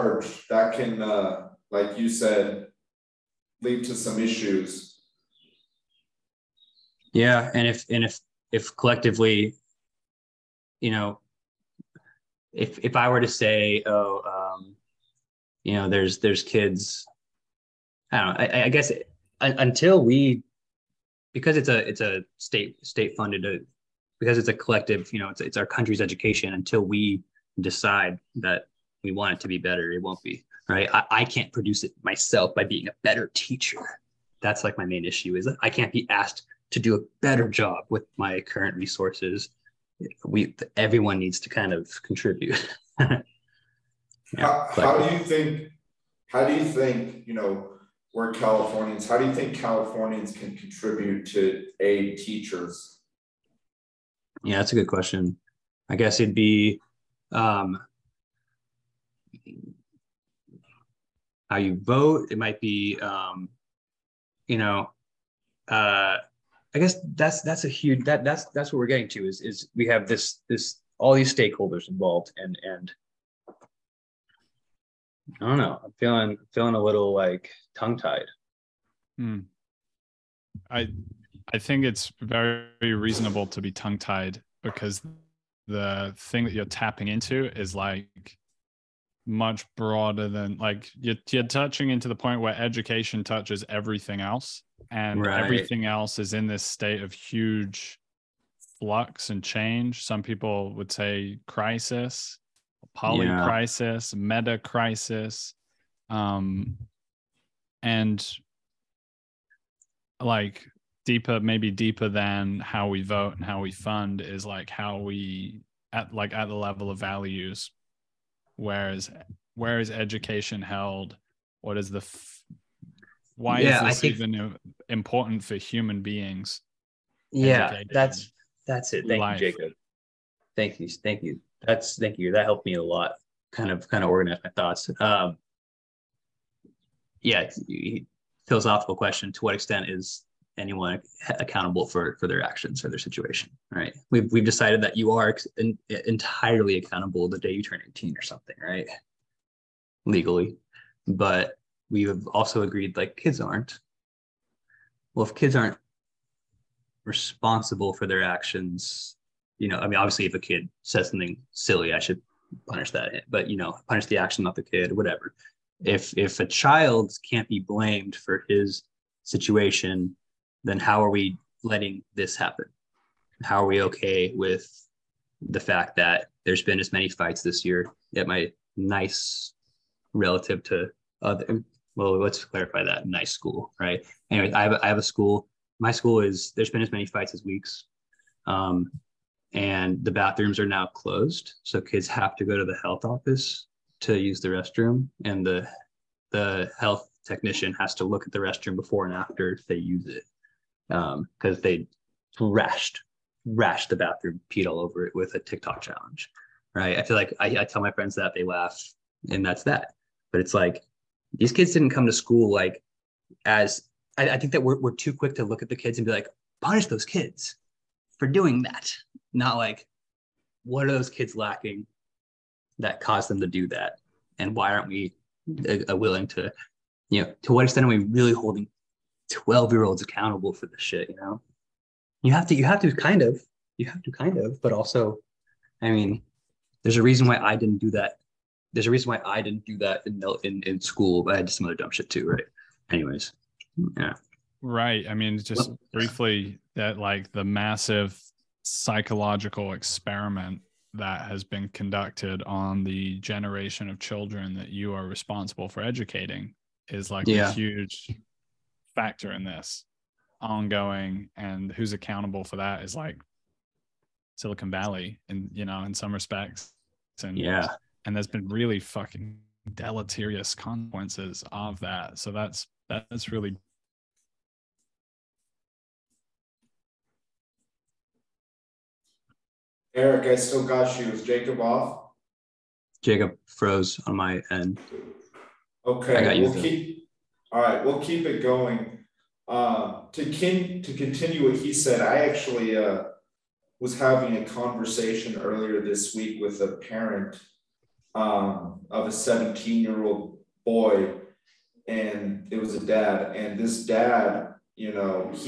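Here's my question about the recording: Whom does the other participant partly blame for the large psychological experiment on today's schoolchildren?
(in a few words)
Silicon Valley.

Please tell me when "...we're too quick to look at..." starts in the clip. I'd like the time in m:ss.
3:34.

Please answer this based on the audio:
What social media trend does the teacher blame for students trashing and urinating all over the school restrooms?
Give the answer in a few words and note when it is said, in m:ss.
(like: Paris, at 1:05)
TikTok challenge, at 3:25.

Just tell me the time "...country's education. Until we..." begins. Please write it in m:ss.
0:25.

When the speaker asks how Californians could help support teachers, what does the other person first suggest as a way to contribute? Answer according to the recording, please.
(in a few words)
how you vote.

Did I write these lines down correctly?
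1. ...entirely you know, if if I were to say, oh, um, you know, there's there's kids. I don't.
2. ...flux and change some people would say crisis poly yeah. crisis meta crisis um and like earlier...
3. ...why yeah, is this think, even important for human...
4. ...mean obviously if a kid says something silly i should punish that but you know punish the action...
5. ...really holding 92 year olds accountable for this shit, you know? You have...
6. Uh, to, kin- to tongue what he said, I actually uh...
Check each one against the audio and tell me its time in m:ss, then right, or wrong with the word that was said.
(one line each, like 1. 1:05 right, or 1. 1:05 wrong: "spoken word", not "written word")
1. 0:08 wrong: "collectively", not "entirely"
2. 1:38 wrong: "deeper", not "earlier"
3. 2:03 right
4. 2:39 right
5. 3:47 wrong: "12", not "92"
6. 4:49 wrong: "continue", not "tongue".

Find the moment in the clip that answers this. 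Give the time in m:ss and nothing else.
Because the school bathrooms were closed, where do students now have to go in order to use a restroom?
3:12.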